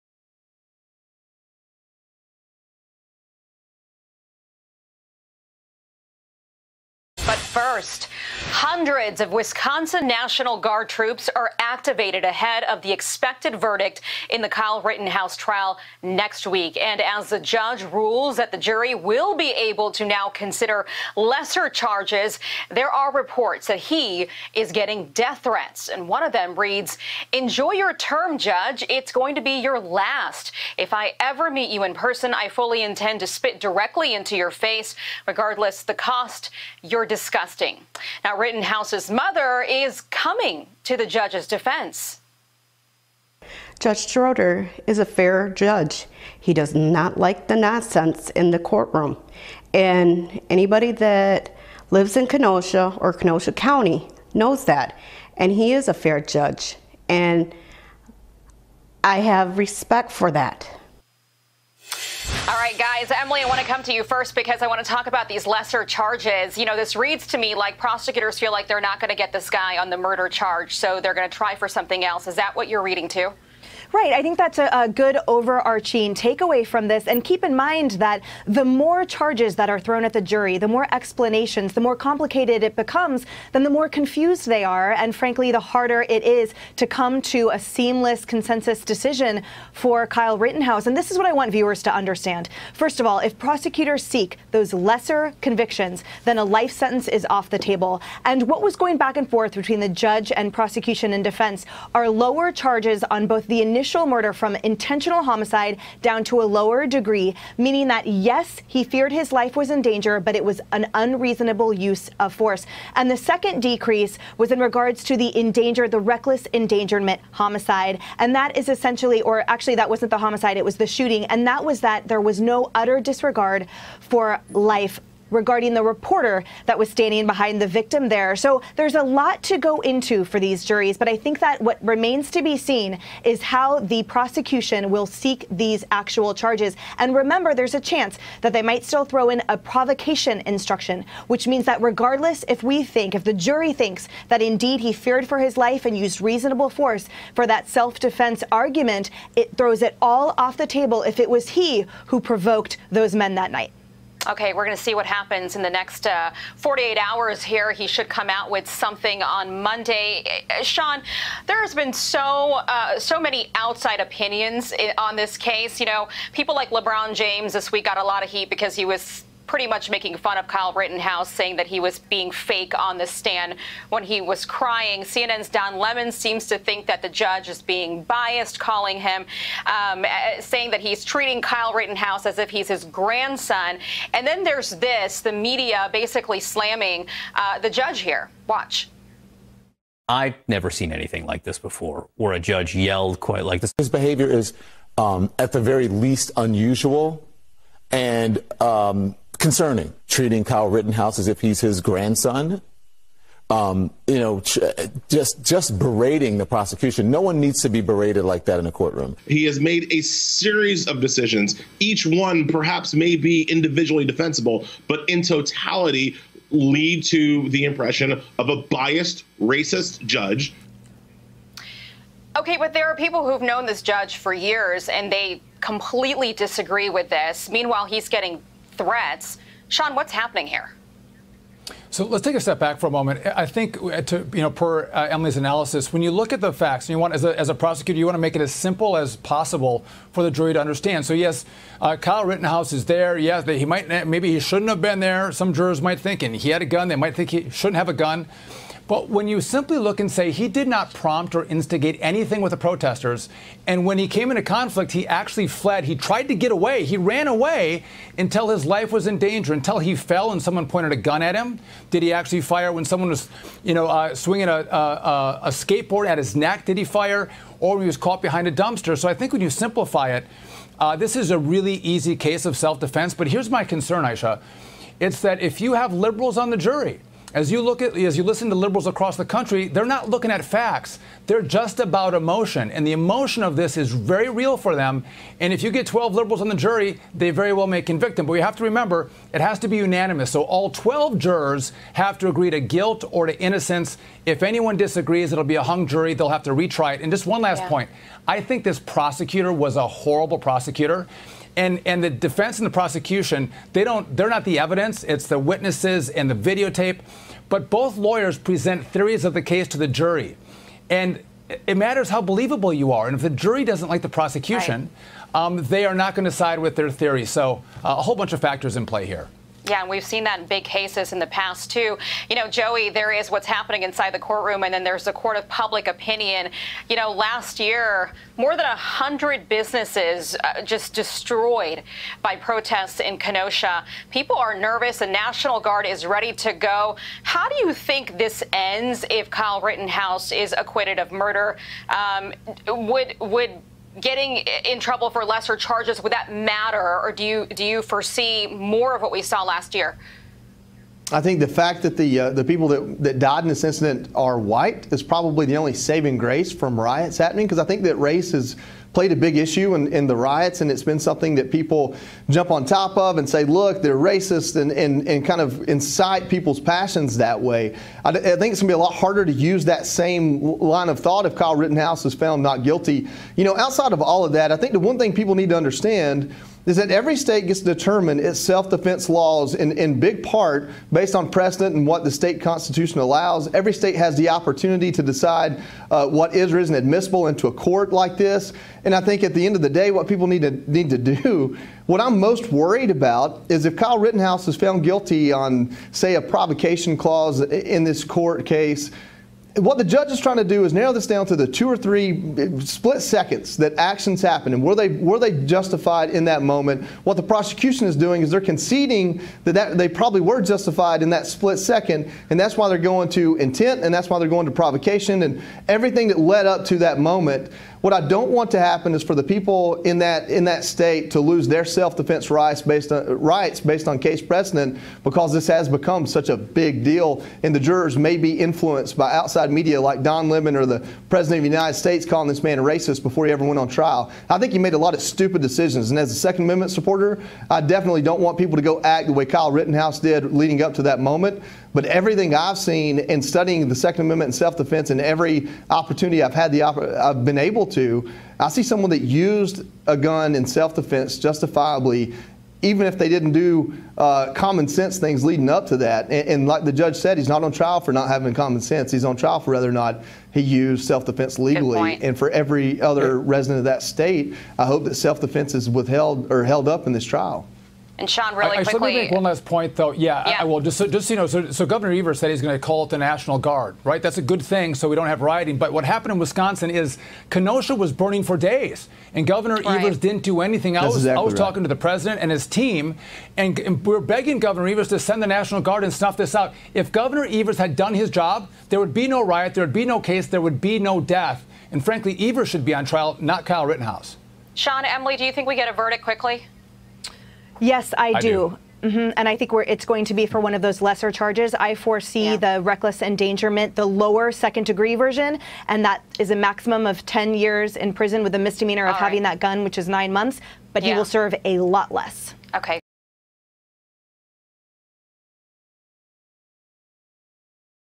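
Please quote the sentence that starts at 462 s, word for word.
And for every other resident of that state, I hope that self defense is withheld or held up in this trial.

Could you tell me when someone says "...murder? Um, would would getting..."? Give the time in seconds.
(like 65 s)
341 s.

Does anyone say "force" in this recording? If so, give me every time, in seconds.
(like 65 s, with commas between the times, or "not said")
112 s, 146 s.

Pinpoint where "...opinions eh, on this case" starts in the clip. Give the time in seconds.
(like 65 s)
163 s.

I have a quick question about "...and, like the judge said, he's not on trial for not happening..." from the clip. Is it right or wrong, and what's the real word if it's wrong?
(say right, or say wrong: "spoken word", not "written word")
wrong: "having", not "happening".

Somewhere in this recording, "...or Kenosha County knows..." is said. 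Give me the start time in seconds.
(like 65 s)
52 s.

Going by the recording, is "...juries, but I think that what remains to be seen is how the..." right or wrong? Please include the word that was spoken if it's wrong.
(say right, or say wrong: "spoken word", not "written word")
right.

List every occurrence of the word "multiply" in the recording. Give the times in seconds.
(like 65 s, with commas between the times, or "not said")
not said.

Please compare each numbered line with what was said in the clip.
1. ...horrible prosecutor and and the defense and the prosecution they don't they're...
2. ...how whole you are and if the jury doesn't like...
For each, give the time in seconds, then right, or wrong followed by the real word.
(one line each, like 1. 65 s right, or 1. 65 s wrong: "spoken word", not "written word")
1. 299 s right
2. 312 s wrong: "believable", not "whole".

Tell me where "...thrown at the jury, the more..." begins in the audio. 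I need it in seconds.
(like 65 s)
79 s.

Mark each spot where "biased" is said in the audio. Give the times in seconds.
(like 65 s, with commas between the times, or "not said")
178 s, 218 s.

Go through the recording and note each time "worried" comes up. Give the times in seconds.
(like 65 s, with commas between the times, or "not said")
392 s.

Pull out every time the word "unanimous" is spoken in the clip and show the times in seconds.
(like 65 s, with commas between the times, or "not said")
289 s.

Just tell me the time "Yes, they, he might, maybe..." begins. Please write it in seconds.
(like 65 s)
243 s.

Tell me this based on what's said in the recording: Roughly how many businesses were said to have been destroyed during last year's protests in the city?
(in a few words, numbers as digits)
more than 100.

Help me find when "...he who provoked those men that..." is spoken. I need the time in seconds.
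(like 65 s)
151 s.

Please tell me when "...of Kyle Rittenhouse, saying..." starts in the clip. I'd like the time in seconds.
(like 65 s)
170 s.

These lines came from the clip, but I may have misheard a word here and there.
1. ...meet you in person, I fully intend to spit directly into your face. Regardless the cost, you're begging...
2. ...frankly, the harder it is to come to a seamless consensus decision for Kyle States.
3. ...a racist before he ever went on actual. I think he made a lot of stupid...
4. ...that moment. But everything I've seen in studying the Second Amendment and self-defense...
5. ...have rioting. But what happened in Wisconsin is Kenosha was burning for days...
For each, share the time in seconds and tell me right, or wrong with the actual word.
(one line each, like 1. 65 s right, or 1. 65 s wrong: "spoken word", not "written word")
1. 31 s wrong: "disgusting", not "begging"
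2. 85 s wrong: "Rittenhouse", not "States"
3. 432 s wrong: "trial", not "actual"
4. 440 s right
5. 475 s right.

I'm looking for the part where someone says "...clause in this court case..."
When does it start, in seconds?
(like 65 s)
396 s.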